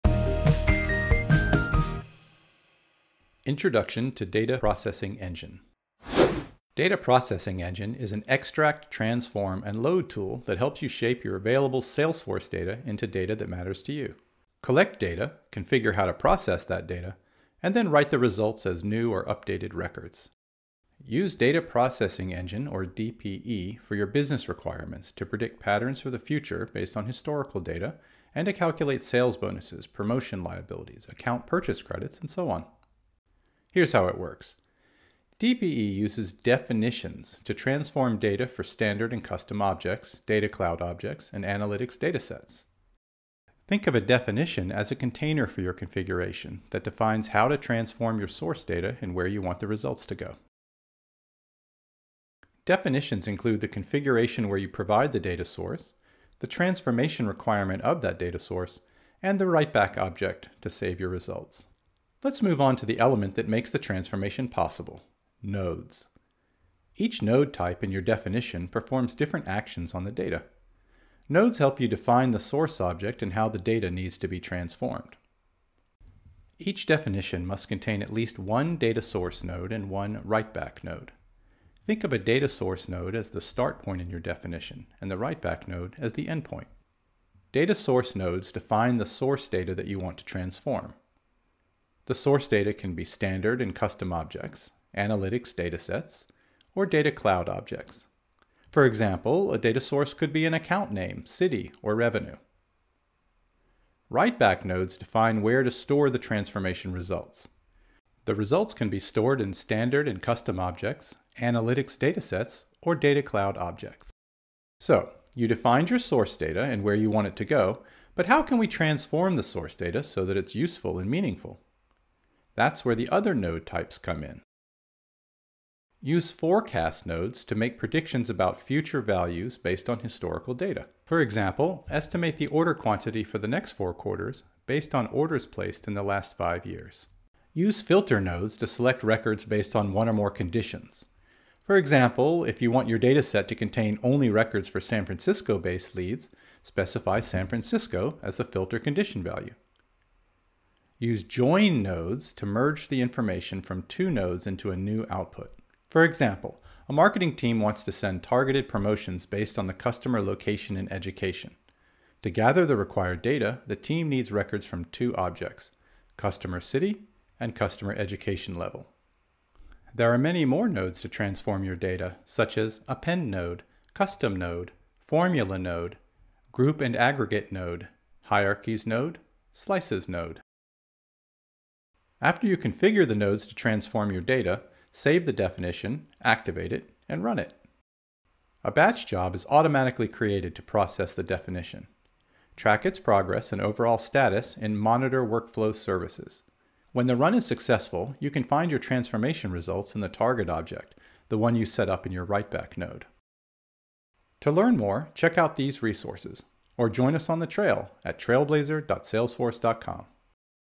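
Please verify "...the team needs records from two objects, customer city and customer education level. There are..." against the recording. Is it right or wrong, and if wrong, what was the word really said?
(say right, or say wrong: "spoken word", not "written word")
right.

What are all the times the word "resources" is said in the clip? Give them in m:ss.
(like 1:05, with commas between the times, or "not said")
3:25.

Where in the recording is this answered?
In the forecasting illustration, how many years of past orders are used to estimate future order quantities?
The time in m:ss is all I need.
2:16.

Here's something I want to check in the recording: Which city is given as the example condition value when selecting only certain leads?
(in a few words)
San Francisco.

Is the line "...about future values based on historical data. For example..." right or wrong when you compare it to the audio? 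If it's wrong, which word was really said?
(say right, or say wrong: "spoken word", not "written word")
right.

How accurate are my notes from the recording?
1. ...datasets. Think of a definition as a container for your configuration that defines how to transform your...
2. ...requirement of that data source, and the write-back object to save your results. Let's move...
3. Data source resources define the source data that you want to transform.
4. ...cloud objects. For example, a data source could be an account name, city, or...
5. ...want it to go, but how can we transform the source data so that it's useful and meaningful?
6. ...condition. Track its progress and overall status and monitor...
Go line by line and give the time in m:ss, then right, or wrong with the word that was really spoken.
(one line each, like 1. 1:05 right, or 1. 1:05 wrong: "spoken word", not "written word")
1. 0:41 right
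2. 0:57 right
3. 1:27 wrong: "nodes", not "resources"
4. 1:37 right
5. 1:57 right
6. 3:11 wrong: "definition", not "condition".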